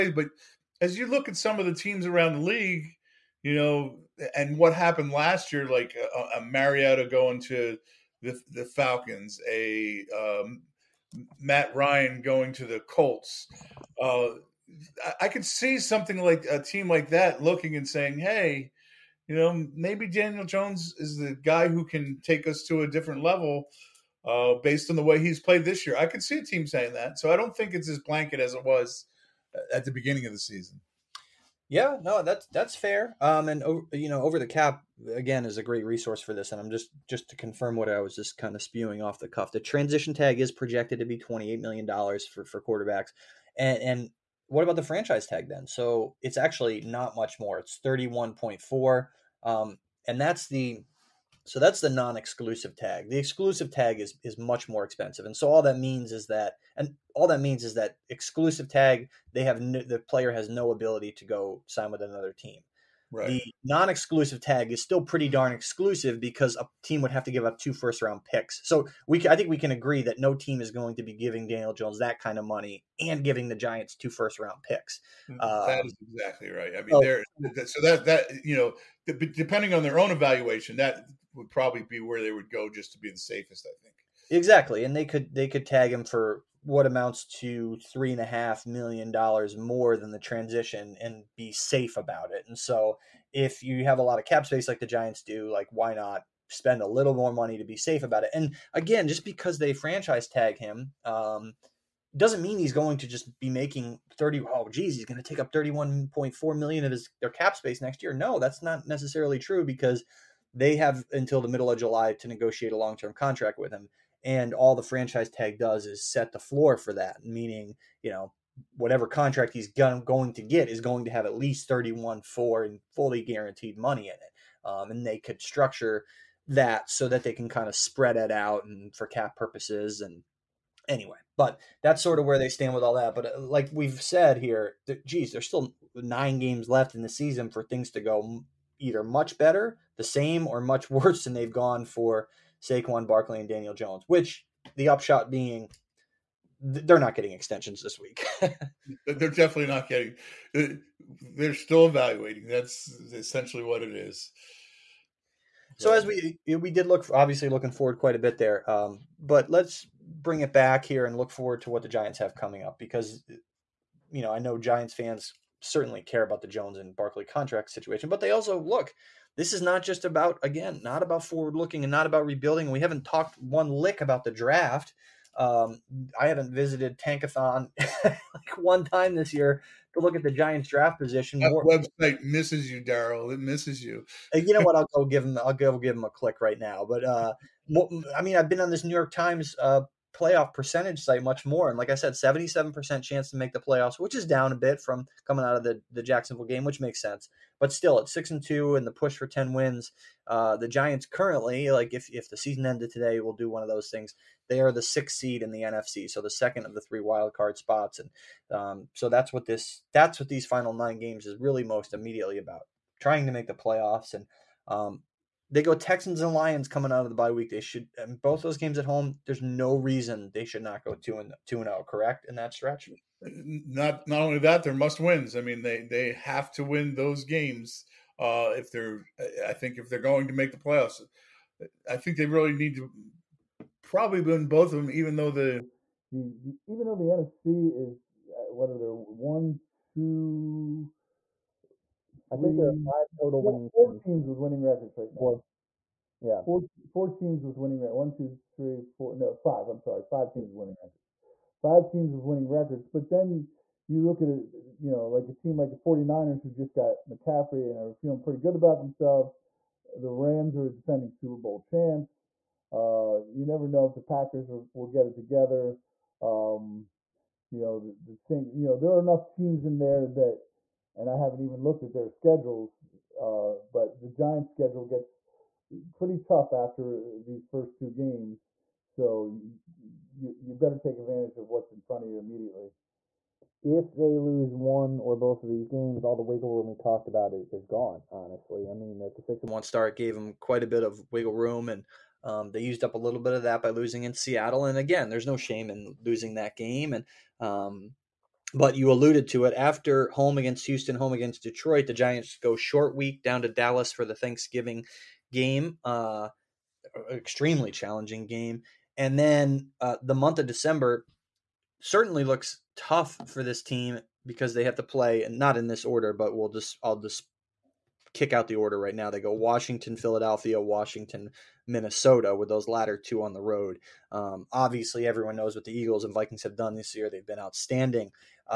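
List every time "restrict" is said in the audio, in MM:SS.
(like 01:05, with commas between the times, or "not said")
not said.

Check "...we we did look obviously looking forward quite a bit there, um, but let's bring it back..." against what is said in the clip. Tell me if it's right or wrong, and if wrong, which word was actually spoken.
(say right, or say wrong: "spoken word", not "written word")
right.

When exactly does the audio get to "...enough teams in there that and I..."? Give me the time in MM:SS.
04:28.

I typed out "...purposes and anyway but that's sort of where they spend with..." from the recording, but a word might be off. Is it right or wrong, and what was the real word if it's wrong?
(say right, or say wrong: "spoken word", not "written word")
wrong: "stand", not "spend".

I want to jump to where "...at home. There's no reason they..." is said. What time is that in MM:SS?
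03:38.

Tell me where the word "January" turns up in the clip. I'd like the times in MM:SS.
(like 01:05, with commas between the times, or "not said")
not said.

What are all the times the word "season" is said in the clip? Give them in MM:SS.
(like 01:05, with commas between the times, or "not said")
00:30, 02:17, 03:22.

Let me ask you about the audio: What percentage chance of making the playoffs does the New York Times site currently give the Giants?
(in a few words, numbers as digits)
77%.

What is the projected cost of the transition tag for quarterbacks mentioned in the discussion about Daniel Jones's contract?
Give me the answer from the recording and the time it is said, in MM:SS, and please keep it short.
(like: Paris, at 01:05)
$28 million, at 00:41.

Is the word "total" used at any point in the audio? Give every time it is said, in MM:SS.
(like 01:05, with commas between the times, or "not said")
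04:03.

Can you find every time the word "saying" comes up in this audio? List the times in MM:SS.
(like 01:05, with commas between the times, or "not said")
00:17, 00:26.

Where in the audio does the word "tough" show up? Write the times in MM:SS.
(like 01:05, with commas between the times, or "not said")
04:36, 05:12.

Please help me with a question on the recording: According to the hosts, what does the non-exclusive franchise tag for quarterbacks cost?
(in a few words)
31.4 million.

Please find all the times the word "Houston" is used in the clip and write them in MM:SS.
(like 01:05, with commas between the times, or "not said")
05:00.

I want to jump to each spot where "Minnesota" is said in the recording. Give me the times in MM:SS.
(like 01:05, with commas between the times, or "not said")
05:21.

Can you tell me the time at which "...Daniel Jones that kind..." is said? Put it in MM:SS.
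01:11.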